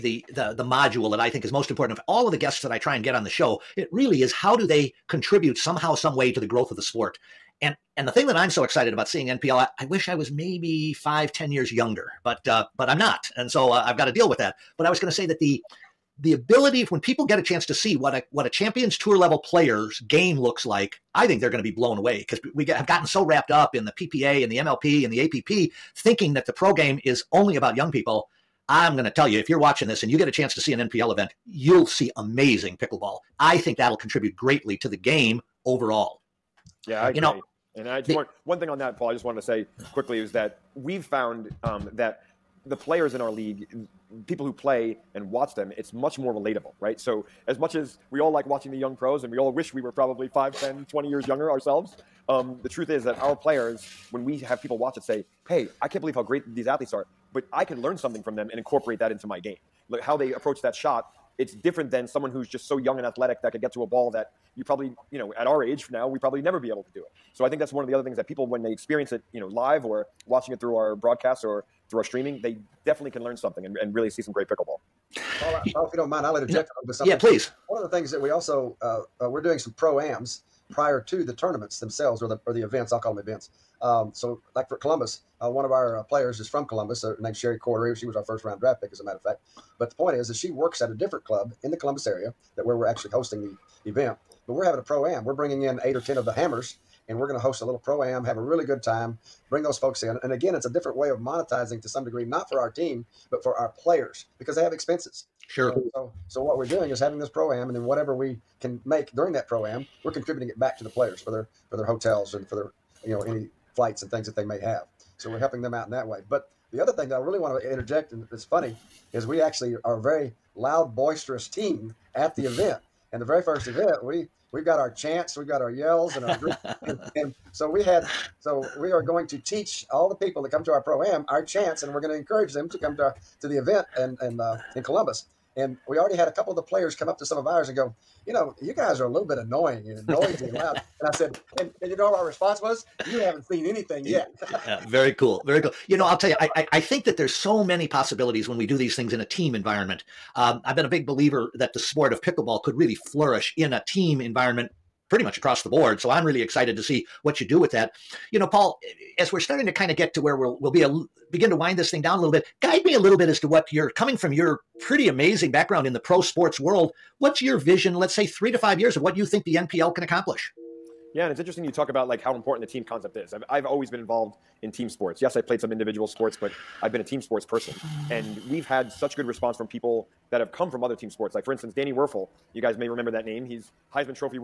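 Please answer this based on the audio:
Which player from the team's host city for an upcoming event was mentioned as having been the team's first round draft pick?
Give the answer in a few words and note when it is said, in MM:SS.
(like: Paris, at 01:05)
Sherry Cordery, at 01:27.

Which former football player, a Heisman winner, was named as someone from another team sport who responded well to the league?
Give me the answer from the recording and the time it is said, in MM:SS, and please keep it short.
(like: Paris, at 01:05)
Danny Wuerffel, at 03:01.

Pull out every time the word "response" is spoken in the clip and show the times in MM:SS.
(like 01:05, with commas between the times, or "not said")
02:22, 02:59.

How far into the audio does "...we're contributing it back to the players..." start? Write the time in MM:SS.
01:50.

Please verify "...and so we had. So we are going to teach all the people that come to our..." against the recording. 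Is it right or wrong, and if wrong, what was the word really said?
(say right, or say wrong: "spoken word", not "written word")
right.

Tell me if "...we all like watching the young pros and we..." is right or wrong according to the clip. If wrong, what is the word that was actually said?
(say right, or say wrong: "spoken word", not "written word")
right.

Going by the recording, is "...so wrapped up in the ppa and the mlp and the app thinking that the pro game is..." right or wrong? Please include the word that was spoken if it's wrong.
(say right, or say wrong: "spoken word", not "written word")
right.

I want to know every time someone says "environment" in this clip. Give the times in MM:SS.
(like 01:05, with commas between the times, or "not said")
02:29, 02:34.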